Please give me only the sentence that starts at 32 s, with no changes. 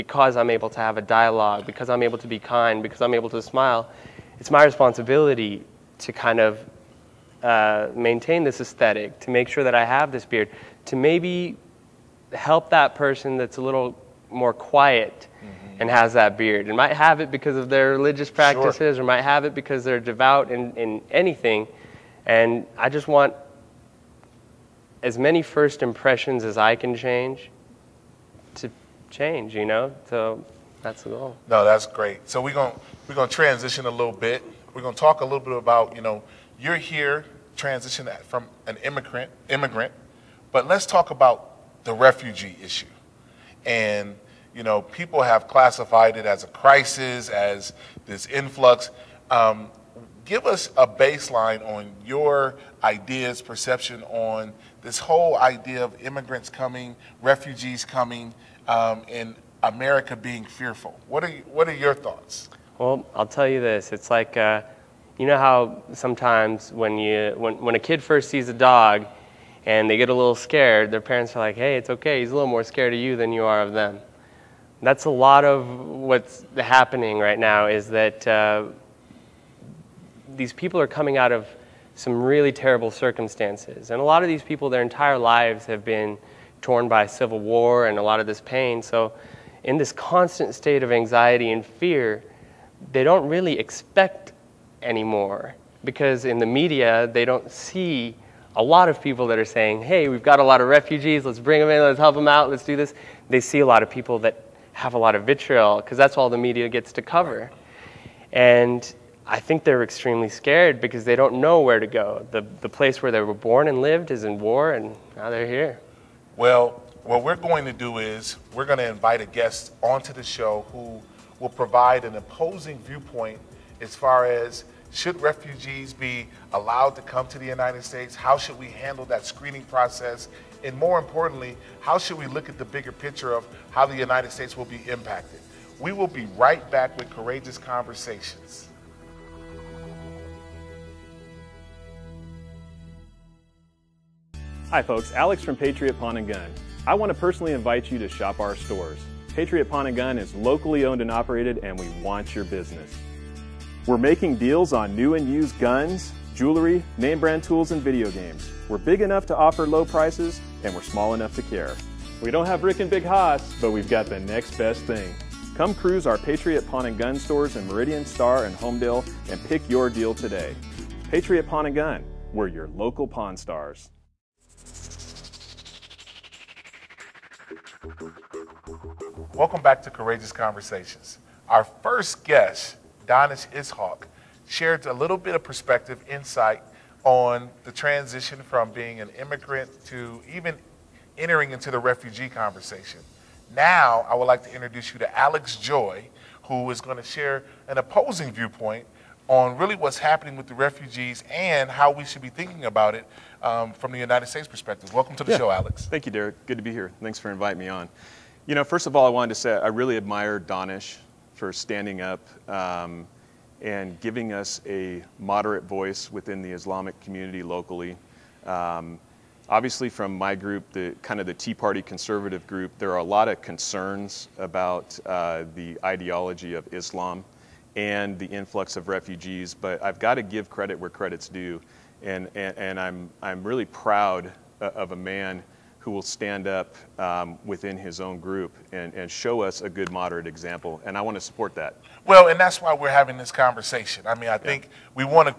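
So we're going we're going to transition a little bit.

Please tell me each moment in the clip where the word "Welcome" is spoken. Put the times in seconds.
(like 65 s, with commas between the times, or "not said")
179 s, 204 s.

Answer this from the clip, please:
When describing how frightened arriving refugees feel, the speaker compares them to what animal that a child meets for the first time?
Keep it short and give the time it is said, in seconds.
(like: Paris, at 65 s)
A dog, at 68 s.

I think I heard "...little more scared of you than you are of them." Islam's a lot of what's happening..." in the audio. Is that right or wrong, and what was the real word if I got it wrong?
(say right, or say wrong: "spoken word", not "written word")
wrong: "That", not "Islam".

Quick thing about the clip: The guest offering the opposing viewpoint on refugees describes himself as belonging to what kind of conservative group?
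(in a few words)
Tea Party.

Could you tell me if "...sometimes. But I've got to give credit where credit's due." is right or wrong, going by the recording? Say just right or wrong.
wrong.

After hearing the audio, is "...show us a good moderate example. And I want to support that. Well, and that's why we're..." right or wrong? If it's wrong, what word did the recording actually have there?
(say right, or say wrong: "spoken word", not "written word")
right.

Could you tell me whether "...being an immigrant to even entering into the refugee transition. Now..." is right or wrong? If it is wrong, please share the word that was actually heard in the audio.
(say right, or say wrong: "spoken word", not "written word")
wrong: "conversation", not "transition".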